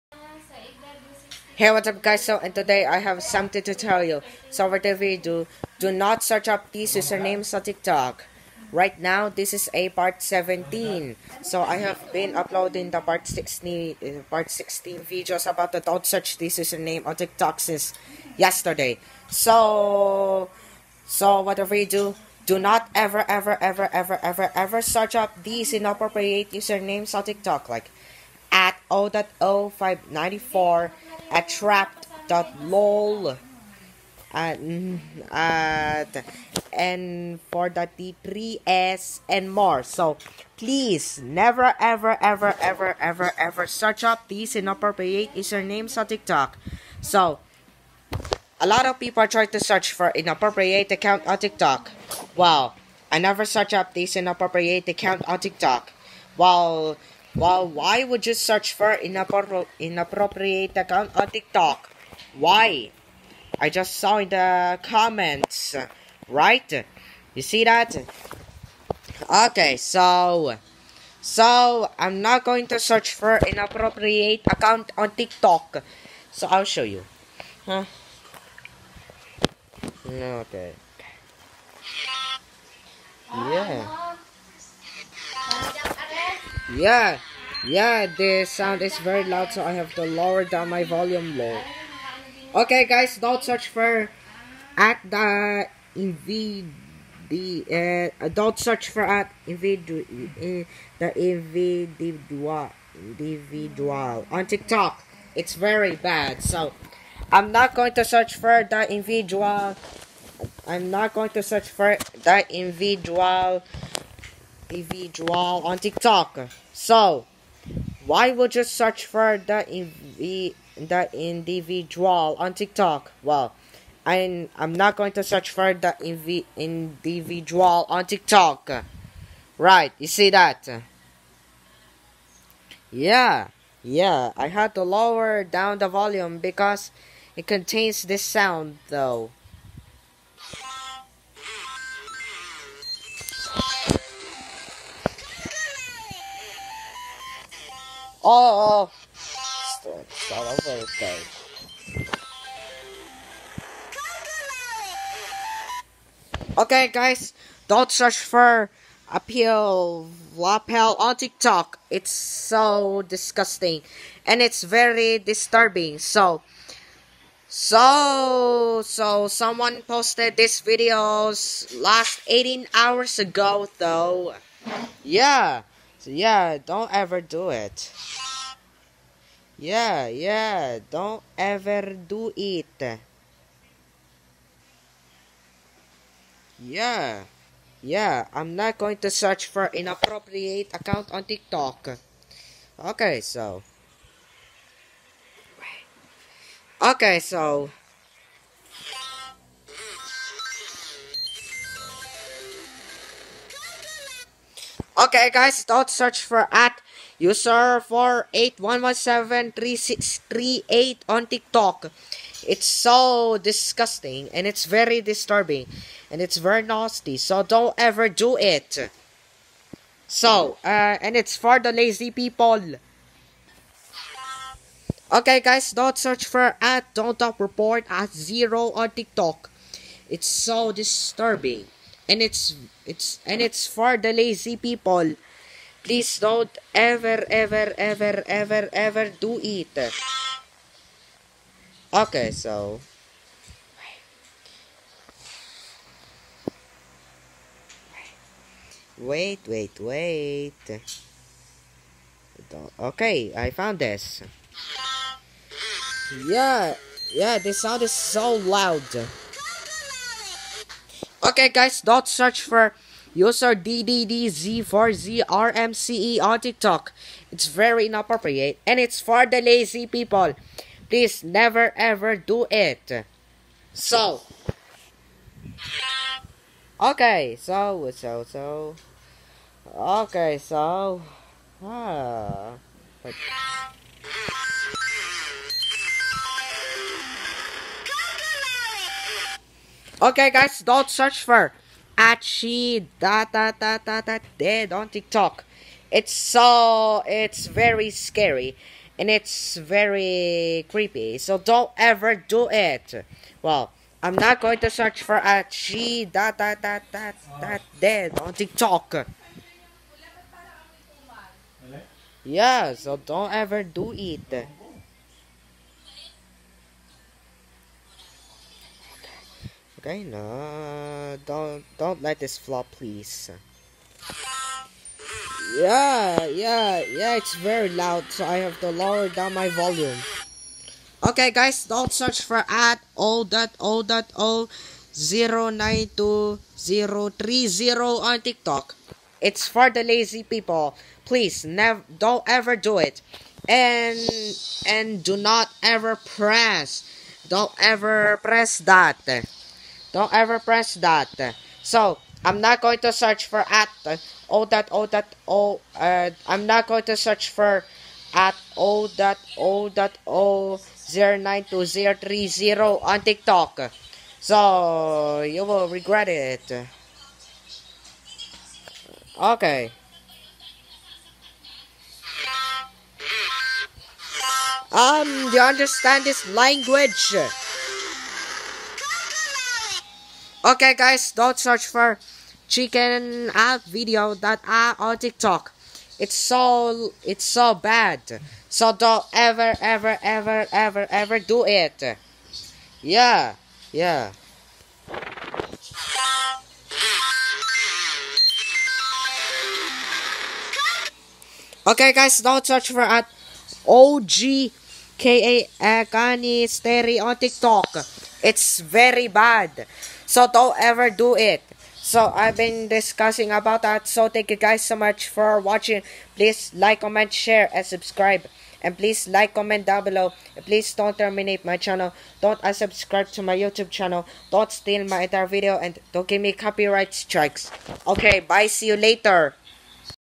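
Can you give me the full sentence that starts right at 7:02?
Don't unsubscribe to my YouTube channel.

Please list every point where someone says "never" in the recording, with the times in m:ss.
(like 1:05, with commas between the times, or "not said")
0:41, 0:53, 4:31, 5:41.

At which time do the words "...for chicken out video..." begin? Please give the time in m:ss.
6:21.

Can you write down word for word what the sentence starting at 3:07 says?
Yeah, I'm not going to search for inappropriate account on TikTok.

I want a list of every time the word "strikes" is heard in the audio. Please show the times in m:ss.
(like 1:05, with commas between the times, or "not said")
7:06.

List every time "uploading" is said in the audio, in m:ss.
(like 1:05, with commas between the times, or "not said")
0:12.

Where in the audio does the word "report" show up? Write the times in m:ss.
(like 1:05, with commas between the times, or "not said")
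3:47.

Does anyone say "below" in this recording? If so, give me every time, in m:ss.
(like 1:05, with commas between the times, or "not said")
6:59.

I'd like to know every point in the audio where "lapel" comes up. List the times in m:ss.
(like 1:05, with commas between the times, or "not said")
2:40.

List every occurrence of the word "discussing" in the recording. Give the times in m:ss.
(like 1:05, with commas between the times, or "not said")
6:52.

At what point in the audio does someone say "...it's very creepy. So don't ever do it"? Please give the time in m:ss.
4:59.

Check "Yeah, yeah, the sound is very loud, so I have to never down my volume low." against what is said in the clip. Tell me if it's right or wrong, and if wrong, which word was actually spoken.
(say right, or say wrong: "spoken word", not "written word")
wrong: "lower", not "never".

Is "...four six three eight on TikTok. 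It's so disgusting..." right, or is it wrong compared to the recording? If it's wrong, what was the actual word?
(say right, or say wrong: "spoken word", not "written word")
wrong: "three", not "four".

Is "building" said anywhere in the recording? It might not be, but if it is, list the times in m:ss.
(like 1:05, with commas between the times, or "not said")
not said.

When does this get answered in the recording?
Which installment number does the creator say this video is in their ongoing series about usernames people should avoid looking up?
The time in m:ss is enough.
0:09.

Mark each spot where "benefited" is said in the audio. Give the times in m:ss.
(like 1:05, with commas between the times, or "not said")
not said.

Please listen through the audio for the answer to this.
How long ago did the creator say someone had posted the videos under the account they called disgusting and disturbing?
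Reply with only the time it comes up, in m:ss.
2:52.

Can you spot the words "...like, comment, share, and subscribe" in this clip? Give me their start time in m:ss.
6:56.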